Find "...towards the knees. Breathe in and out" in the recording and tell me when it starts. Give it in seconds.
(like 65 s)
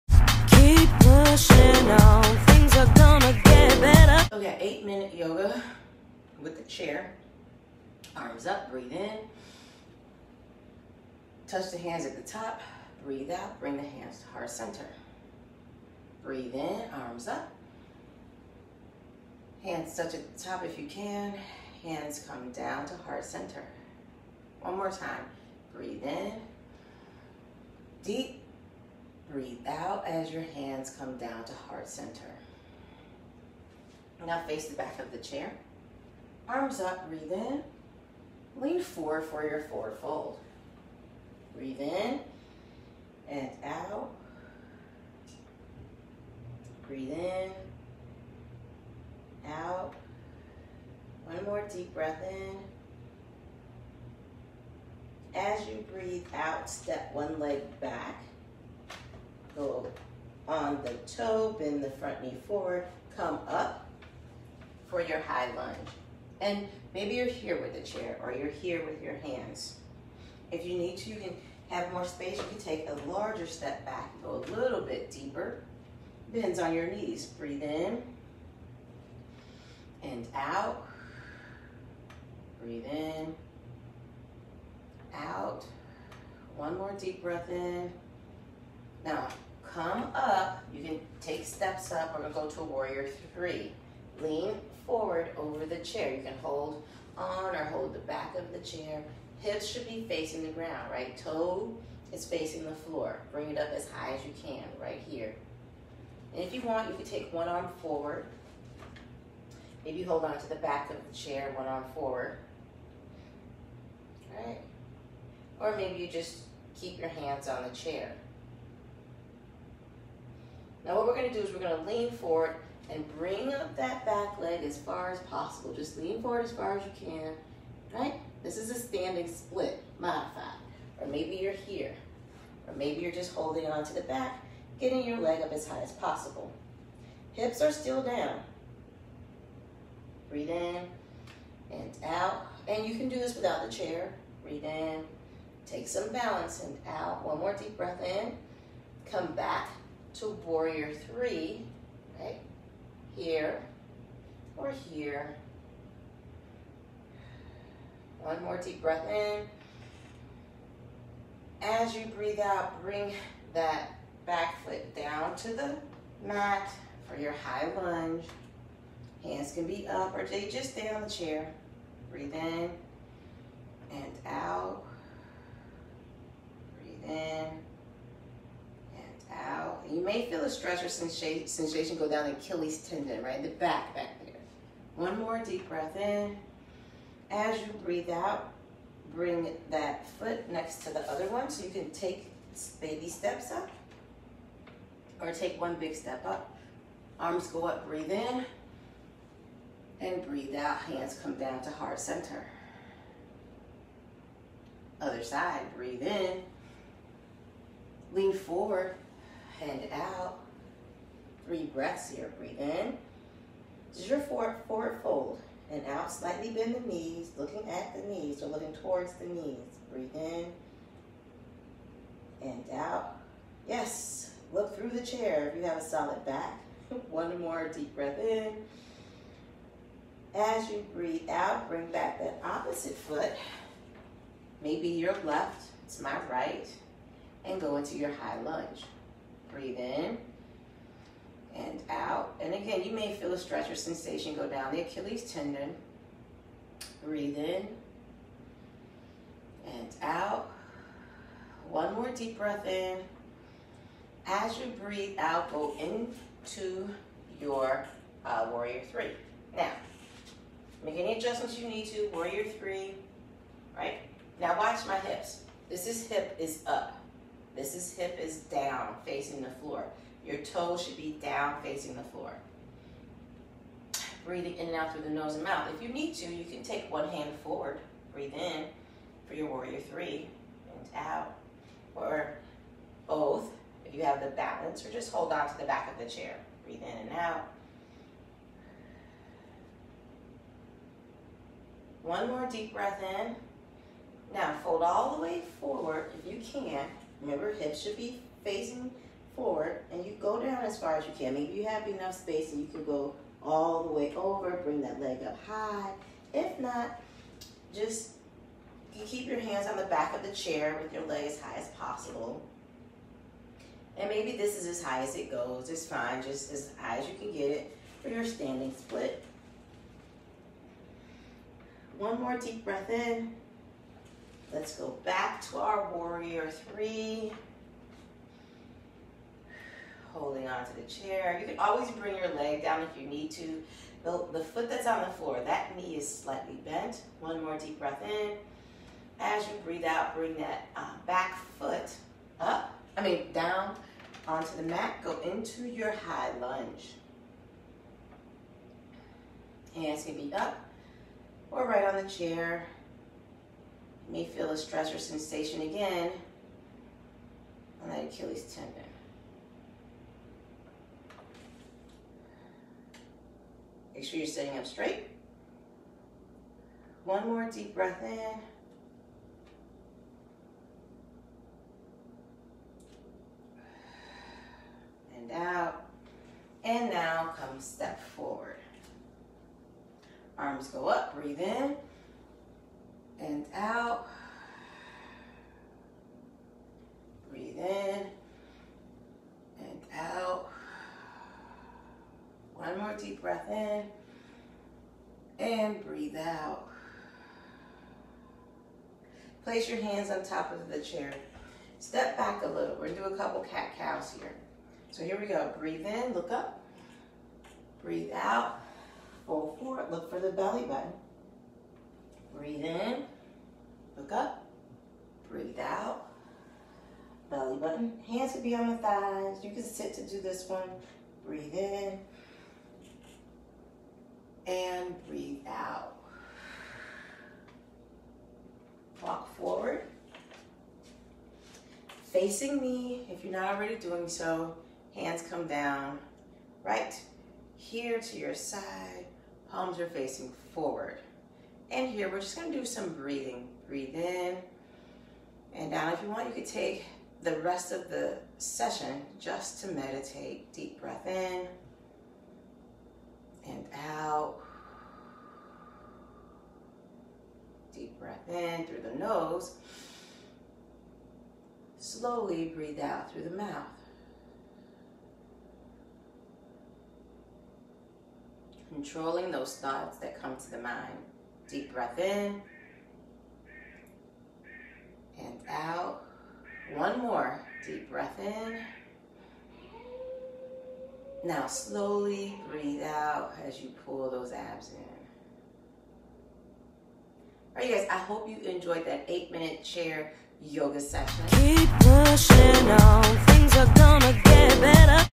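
218 s.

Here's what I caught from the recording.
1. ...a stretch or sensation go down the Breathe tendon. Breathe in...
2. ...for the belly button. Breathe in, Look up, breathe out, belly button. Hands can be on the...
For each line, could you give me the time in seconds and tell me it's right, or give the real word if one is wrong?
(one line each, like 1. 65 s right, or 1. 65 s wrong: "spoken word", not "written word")
1. 243 s wrong: "Achilles", not "Breathe"
2. 410 s right.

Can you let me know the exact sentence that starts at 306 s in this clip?
If not, just you keep your hands on the back of the chair with your leg as high as possible.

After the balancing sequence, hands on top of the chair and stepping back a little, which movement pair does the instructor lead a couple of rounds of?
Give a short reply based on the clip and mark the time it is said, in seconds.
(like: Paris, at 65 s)
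cat cows, at 403 s.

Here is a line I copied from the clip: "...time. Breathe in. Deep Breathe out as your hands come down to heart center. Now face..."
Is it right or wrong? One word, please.
right.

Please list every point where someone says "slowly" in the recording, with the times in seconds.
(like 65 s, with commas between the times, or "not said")
461 s, 481 s.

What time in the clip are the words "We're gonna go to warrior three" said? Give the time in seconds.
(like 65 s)
92 s.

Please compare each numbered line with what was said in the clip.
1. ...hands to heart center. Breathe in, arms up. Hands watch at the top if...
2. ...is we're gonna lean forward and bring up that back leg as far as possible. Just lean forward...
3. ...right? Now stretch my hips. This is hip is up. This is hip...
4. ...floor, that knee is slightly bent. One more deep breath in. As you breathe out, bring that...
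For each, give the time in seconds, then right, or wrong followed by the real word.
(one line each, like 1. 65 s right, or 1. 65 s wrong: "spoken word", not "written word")
1. 13 s wrong: "touch", not "watch"
2. 121 s right
3. 263 s wrong: "watch", not "stretch"
4. 335 s right.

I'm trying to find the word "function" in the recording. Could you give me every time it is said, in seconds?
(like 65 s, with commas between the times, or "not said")
not said.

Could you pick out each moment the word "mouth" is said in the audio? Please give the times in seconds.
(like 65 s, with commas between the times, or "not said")
275 s, 463 s.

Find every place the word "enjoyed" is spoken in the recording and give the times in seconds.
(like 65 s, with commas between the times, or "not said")
488 s.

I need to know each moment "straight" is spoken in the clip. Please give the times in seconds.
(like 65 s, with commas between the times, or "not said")
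364 s.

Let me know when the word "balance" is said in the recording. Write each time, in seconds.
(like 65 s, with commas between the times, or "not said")
146 s, 284 s.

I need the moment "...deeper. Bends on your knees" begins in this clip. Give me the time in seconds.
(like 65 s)
75 s.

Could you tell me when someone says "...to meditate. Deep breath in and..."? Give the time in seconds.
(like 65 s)
449 s.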